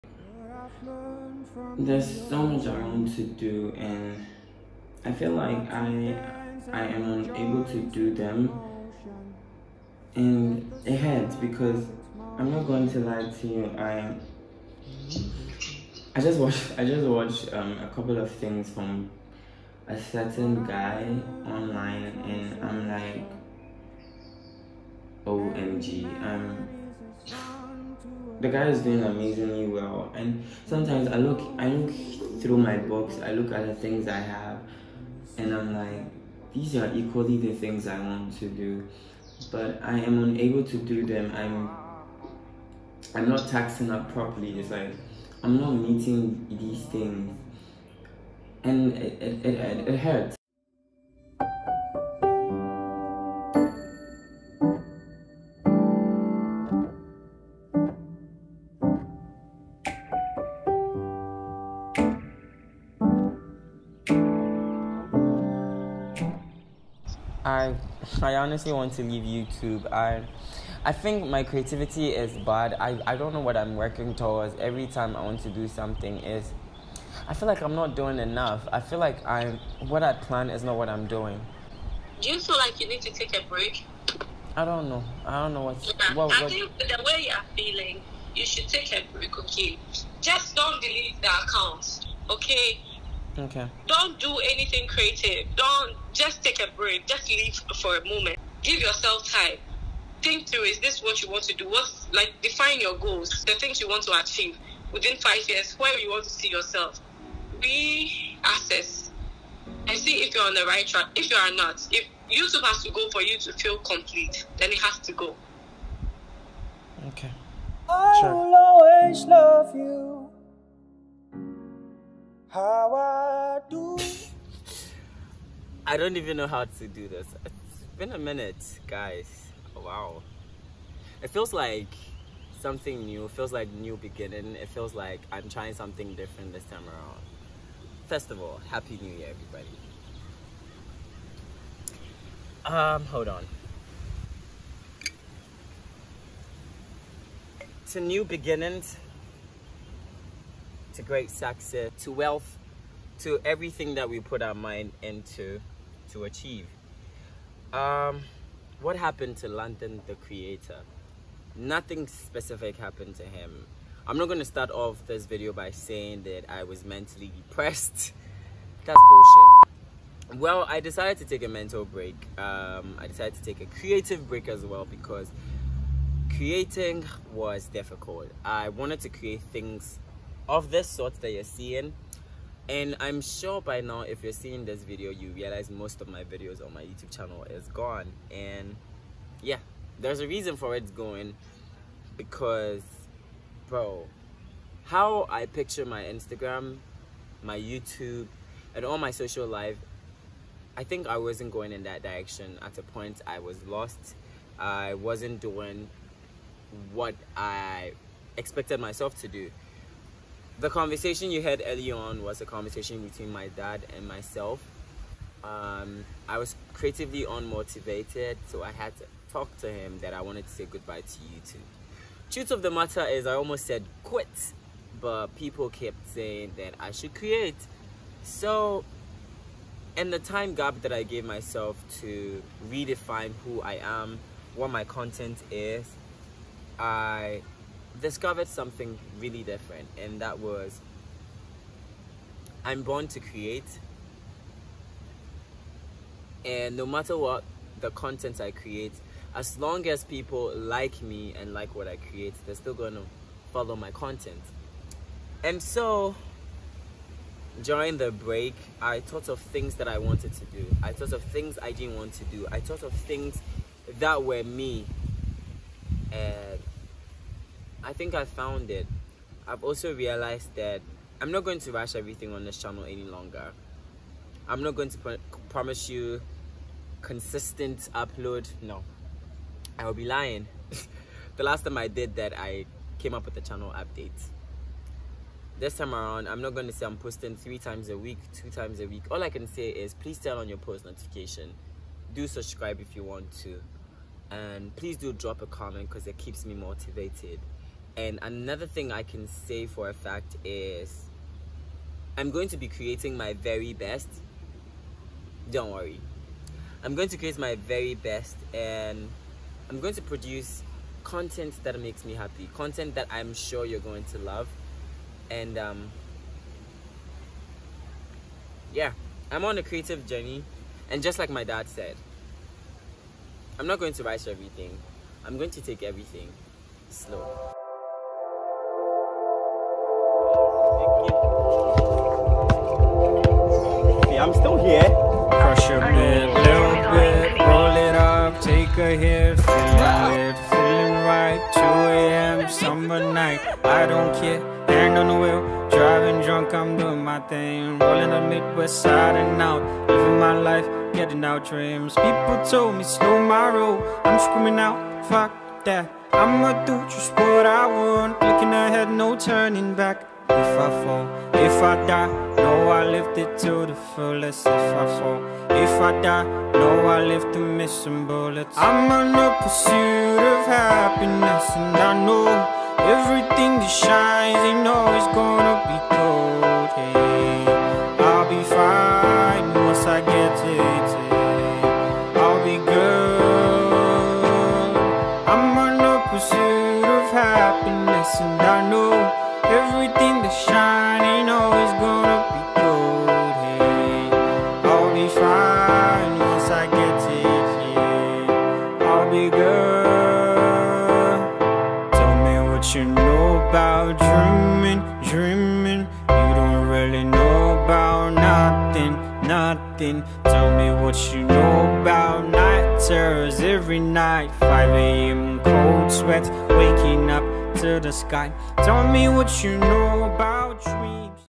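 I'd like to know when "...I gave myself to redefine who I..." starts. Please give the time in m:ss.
3:50.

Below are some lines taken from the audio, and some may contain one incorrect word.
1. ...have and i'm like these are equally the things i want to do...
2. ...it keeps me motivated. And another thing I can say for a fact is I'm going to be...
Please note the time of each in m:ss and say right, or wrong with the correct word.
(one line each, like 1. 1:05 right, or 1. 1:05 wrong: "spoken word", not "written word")
1. 0:34 right
2. 4:56 right.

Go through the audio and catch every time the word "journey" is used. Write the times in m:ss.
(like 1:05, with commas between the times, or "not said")
5:20.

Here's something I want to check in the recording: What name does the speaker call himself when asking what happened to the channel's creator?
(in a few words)
London.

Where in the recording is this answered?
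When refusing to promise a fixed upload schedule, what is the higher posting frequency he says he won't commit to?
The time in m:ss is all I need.
4:47.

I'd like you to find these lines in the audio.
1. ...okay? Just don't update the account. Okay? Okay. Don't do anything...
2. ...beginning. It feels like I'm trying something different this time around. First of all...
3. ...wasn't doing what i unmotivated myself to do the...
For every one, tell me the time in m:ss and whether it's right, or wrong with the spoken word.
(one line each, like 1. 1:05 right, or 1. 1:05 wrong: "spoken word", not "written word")
1. 1:29 wrong: "delete", not "update"
2. 2:13 right
3. 3:24 wrong: "expected", not "unmotivated".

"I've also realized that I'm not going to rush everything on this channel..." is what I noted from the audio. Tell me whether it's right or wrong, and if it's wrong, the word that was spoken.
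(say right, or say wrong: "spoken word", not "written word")
right.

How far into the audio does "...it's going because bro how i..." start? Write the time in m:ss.
3:10.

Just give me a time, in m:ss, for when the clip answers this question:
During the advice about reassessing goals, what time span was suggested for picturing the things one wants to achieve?
1:45.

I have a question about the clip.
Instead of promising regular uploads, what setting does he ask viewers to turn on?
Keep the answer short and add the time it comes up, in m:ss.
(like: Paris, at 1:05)
post notification, at 4:50.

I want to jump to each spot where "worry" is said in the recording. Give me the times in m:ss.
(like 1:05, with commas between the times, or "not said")
5:05.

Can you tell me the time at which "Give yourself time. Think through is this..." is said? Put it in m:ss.
1:38.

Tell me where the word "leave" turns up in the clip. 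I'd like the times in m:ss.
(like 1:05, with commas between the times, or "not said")
1:09, 1:37.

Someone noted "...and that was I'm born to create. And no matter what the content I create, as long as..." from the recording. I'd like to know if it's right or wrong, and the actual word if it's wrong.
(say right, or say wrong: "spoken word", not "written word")
right.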